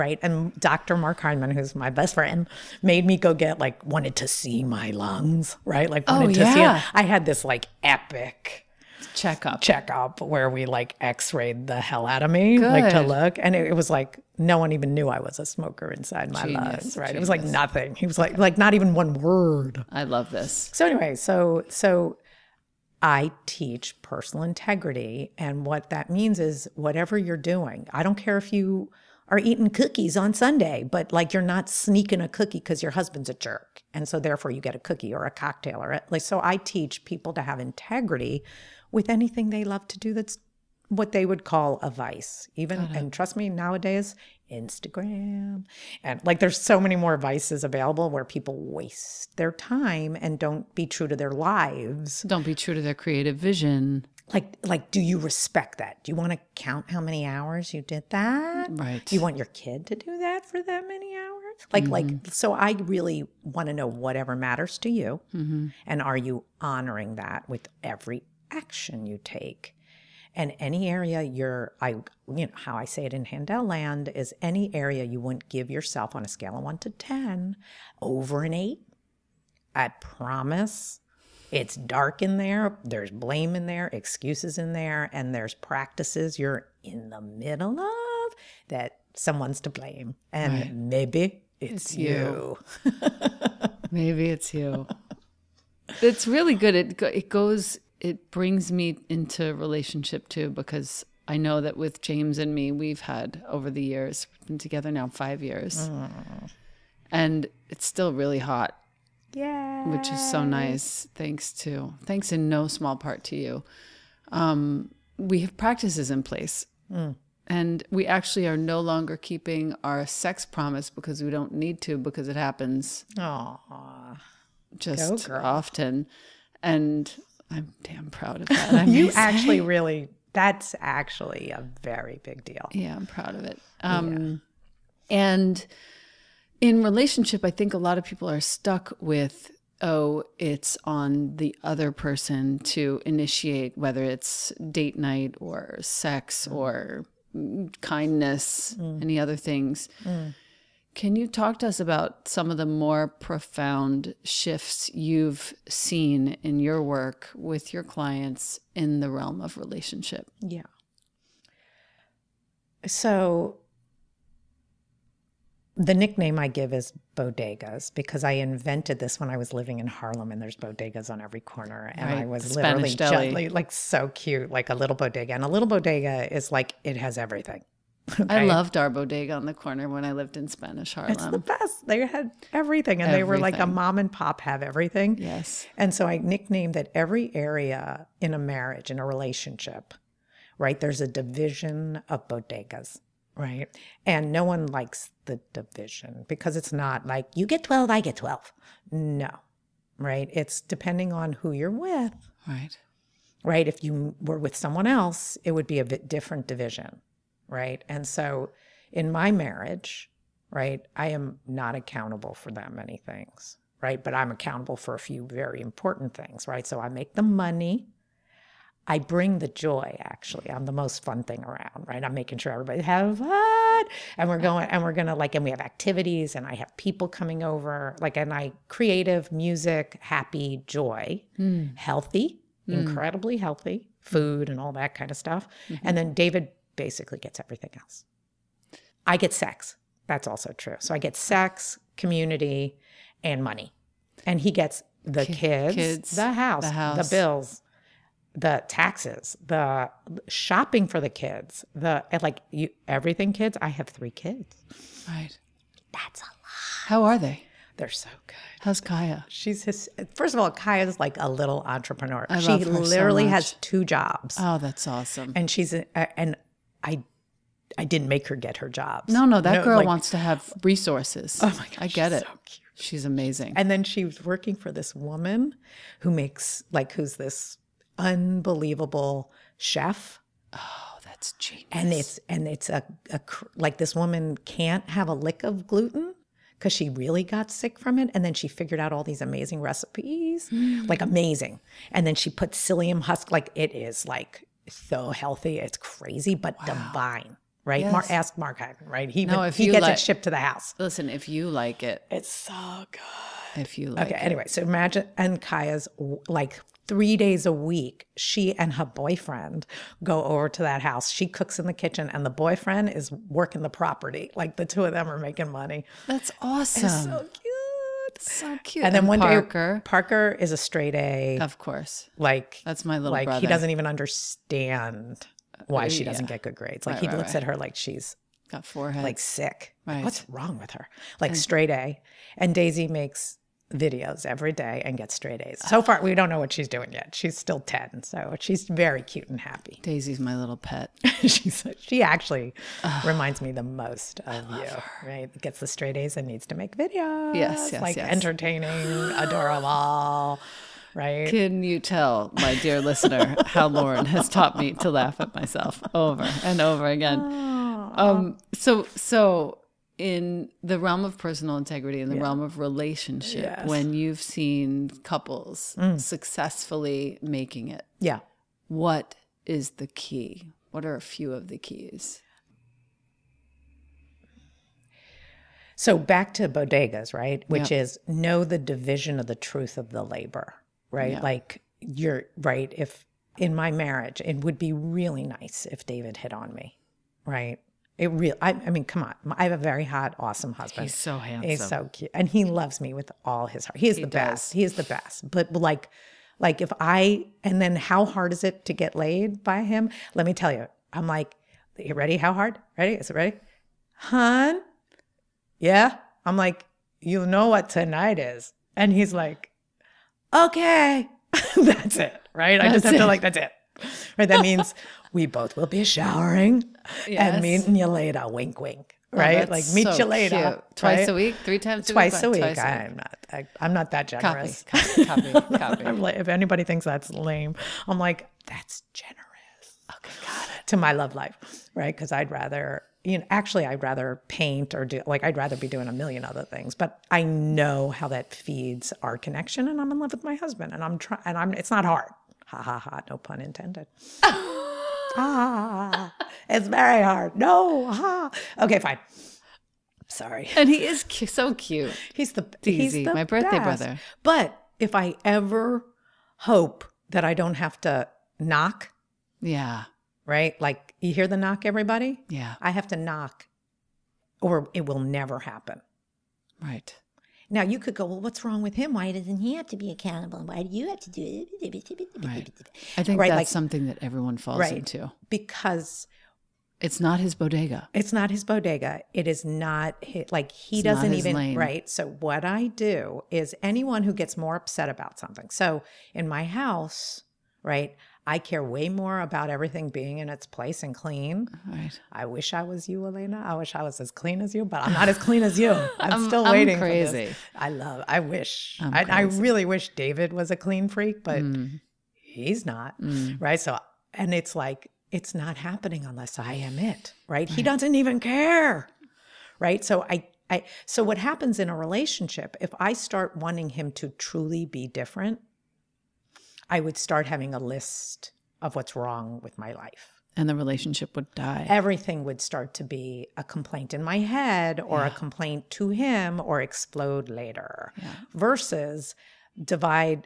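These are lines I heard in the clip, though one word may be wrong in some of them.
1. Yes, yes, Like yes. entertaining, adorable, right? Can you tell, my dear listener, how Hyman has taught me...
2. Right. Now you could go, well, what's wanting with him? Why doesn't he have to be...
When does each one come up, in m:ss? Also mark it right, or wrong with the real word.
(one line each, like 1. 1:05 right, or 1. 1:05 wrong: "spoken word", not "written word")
1. 5:47 wrong: "Lauren", not "Hyman"
2. 7:46 wrong: "wrong", not "wanting".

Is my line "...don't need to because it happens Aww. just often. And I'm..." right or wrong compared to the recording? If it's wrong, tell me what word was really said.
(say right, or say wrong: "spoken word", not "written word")
right.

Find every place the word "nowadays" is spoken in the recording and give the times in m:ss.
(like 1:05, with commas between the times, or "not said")
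0:43.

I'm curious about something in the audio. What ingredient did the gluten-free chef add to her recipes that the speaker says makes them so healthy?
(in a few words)
psyllium husk.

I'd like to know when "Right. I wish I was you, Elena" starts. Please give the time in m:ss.
8:11.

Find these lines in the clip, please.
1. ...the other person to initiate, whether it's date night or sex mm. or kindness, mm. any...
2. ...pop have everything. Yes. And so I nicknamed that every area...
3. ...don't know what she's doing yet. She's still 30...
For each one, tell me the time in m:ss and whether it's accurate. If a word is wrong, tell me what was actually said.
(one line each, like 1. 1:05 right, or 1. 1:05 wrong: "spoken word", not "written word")
1. 2:21 right
2. 3:04 right
3. 5:36 wrong: "10", not "30".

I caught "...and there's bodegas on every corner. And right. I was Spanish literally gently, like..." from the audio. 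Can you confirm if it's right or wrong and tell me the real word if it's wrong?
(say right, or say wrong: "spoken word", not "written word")
right.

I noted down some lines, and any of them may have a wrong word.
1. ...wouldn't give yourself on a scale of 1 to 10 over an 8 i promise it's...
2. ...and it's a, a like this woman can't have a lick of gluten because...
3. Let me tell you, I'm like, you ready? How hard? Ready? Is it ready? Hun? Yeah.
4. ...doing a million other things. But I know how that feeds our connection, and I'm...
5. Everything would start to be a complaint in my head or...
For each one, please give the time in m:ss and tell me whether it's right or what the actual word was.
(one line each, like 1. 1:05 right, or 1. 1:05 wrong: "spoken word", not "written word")
1. 1:15 right
2. 4:42 right
3. 6:40 right
4. 7:15 right
5. 8:41 right.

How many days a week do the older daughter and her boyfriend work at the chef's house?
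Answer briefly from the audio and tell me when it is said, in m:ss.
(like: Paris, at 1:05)
3, at 5:06.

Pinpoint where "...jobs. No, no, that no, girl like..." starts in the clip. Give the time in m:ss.
4:28.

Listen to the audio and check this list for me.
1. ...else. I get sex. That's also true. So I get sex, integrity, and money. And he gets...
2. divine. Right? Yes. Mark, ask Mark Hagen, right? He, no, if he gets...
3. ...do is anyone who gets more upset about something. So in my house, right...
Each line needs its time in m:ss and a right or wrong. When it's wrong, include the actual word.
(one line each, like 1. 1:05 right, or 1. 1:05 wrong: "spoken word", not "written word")
1. 3:57 wrong: "community", not "integrity"
2. 4:56 right
3. 8:02 right.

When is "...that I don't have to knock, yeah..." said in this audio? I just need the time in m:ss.
7:37.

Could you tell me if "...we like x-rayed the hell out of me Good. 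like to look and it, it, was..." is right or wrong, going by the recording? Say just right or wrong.
right.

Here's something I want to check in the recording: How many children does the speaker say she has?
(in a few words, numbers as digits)
3.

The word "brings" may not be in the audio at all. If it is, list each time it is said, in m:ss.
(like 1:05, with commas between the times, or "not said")
1:38, 3:38.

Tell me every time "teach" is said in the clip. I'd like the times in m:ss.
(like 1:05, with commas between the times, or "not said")
0:23, 0:36.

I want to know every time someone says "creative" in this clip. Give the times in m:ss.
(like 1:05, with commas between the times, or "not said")
0:52, 3:48.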